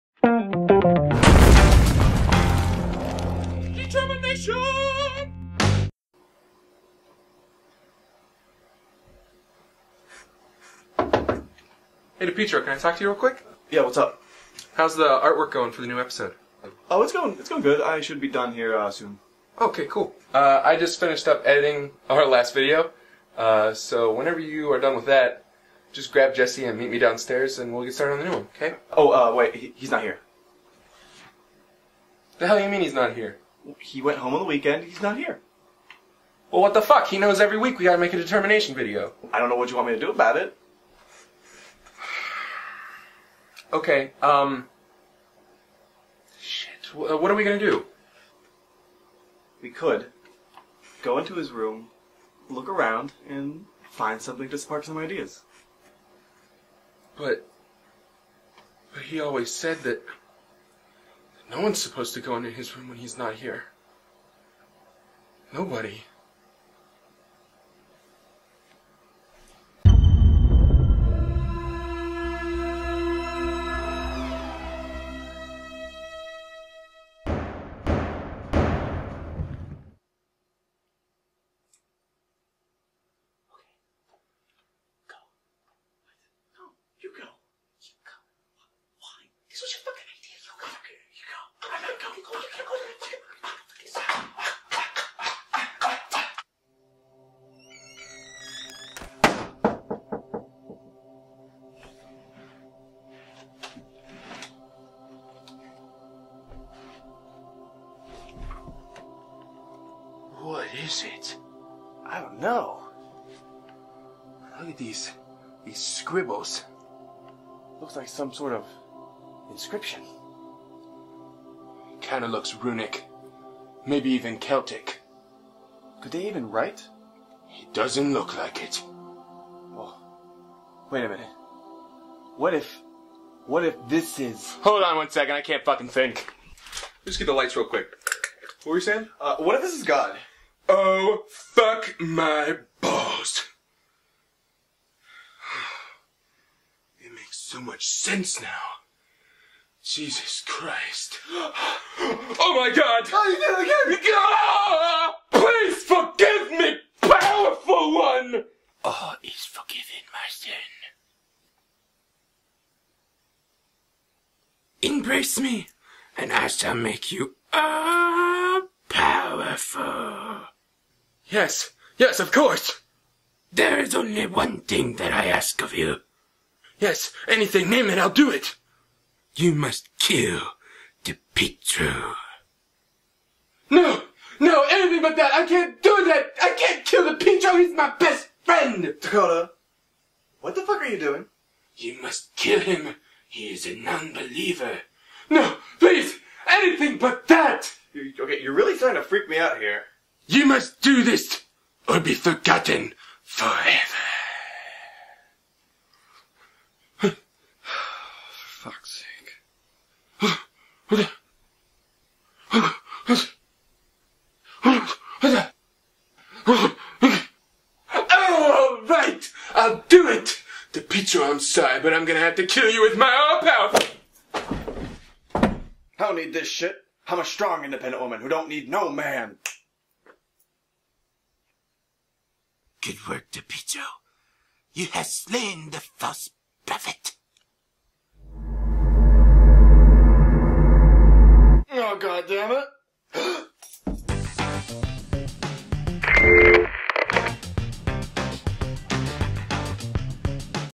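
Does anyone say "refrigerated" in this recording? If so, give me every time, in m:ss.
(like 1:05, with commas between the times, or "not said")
not said.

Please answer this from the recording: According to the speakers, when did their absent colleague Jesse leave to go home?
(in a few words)
On the weekend.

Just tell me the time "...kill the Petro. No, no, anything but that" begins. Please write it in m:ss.
2:59.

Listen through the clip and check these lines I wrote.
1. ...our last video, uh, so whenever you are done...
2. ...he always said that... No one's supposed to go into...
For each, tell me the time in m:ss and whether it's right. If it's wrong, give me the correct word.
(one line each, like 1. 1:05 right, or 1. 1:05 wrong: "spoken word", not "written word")
1. 0:22 right
2. 0:59 right.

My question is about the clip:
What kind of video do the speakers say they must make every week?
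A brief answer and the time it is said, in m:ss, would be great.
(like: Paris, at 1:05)
A determination video, at 0:38.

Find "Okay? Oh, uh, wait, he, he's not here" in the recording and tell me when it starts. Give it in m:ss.
0:28.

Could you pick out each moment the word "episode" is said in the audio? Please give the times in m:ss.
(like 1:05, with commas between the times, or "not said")
0:15.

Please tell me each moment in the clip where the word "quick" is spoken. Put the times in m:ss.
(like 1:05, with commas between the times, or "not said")
0:13, 2:17.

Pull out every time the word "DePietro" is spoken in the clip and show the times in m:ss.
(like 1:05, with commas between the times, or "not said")
0:12, 3:07, 3:53.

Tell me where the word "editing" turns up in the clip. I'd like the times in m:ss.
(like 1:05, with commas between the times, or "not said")
0:21.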